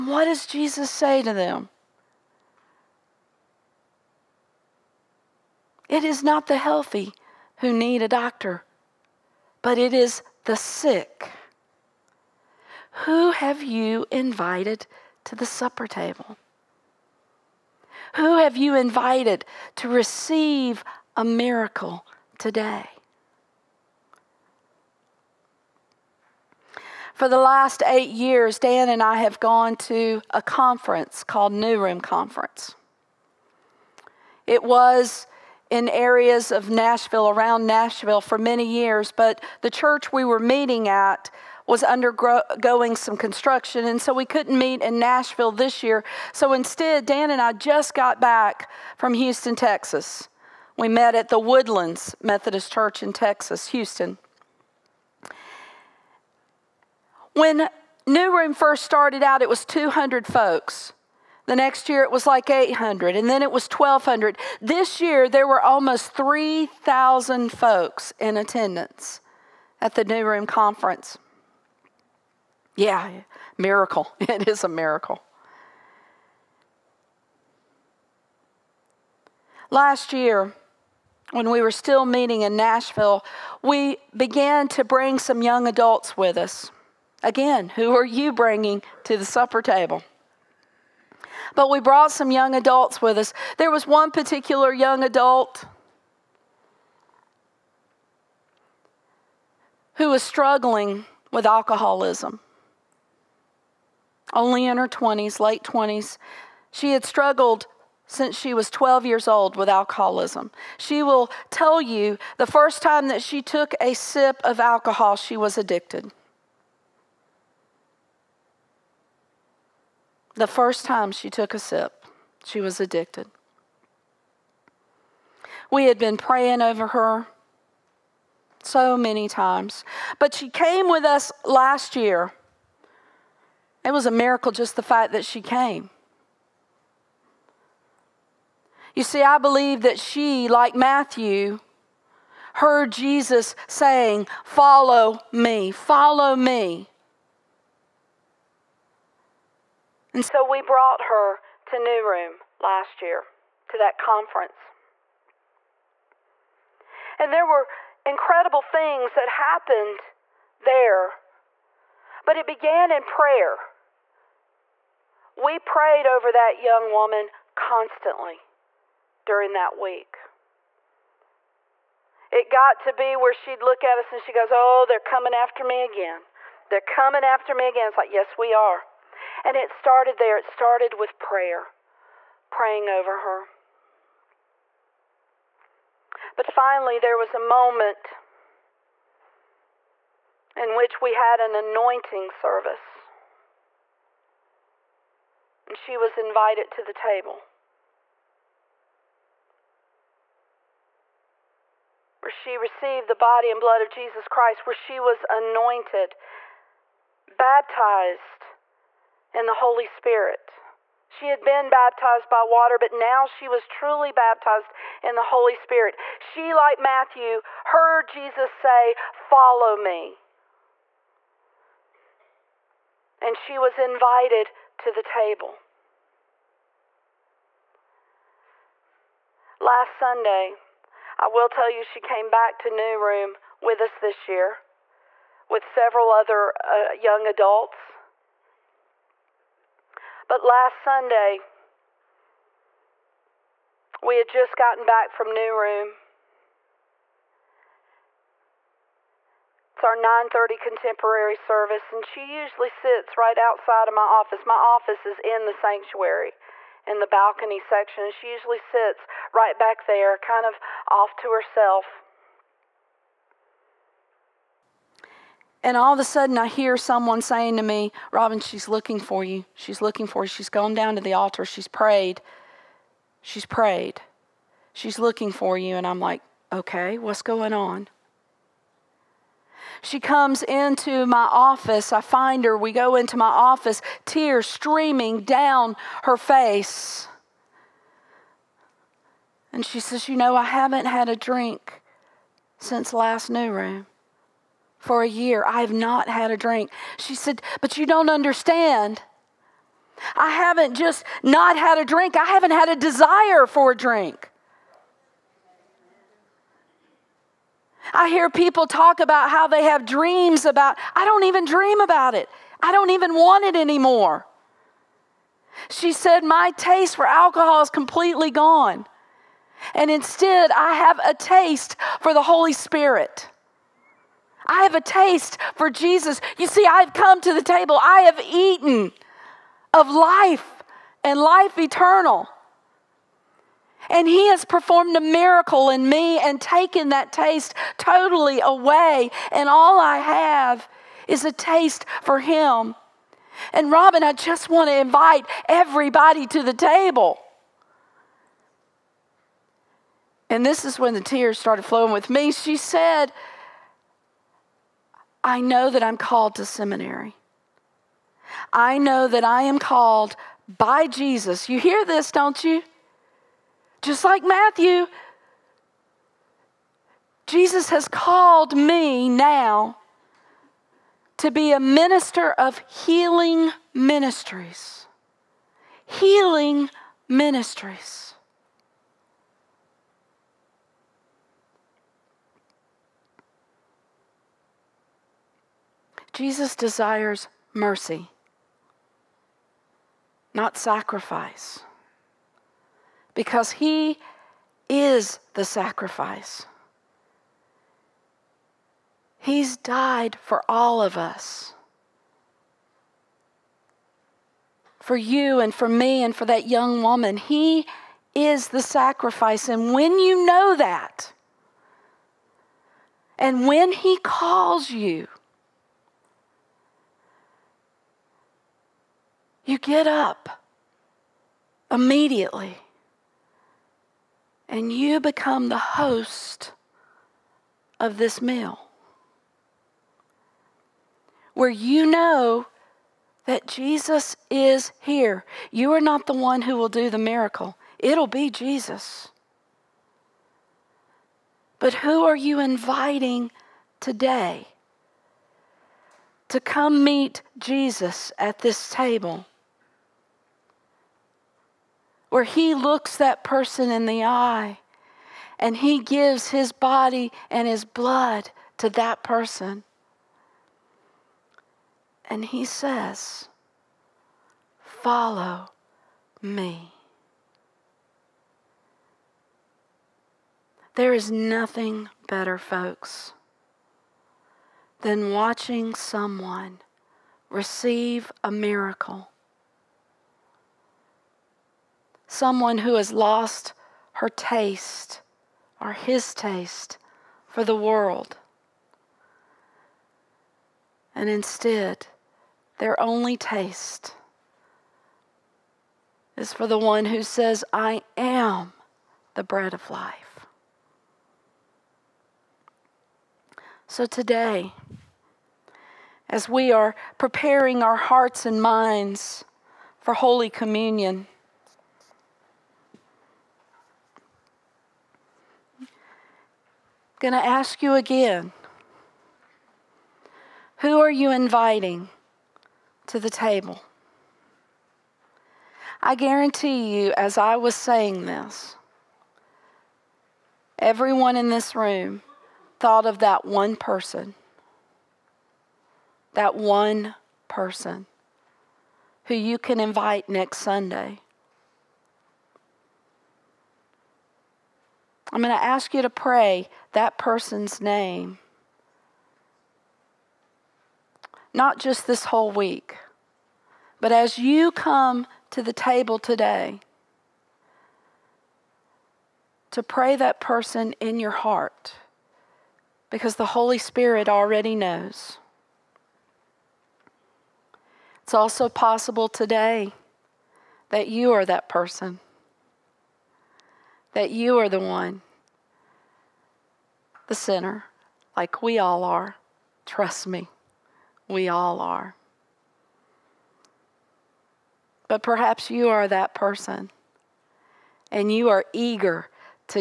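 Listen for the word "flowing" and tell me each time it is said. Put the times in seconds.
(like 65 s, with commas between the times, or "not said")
351 s.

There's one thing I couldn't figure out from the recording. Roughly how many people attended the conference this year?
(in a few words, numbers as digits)
3,000.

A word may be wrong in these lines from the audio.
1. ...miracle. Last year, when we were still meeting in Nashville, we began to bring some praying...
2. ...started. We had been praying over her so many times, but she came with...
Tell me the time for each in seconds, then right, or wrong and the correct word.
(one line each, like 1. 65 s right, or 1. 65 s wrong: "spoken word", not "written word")
1. 74 s wrong: "young", not "praying"
2. 122 s wrong: "addicted", not "started".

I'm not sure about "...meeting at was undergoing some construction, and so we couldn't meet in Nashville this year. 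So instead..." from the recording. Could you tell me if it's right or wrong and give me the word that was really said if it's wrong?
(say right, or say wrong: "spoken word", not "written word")
right.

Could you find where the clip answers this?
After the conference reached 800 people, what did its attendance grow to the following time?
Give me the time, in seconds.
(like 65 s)
63 s.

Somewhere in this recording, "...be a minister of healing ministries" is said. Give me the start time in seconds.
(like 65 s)
371 s.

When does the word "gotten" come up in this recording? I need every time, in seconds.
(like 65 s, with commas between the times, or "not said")
244 s.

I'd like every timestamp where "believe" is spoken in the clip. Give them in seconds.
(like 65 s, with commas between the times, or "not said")
139 s.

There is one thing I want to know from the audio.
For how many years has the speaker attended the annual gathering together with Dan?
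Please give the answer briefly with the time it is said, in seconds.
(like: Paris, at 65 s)
8 years, at 27 s.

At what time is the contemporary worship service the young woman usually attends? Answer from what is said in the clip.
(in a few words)
9:30.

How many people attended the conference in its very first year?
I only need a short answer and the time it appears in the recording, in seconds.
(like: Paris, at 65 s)
200, at 59 s.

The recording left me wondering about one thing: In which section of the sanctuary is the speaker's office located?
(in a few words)
The balcony.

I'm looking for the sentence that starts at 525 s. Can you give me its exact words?
I guarantee you, as I was saying this, everyone in this room thought of that one person.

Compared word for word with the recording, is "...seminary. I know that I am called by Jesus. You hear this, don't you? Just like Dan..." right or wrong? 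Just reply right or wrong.
wrong.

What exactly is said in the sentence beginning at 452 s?
where he looks that person in the eye and he gives his body and his blood to that person.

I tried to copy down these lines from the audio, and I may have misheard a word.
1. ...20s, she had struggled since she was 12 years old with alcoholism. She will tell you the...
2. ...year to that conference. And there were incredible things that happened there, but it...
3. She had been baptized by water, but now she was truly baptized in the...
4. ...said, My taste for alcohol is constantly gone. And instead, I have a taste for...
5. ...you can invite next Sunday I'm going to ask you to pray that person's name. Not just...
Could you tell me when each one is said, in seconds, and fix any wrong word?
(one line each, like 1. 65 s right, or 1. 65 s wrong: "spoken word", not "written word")
1. 105 s right
2. 153 s right
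3. 211 s right
4. 315 s wrong: "completely", not "constantly"
5. 539 s right.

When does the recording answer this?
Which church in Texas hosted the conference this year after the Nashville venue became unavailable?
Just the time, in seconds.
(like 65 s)
51 s.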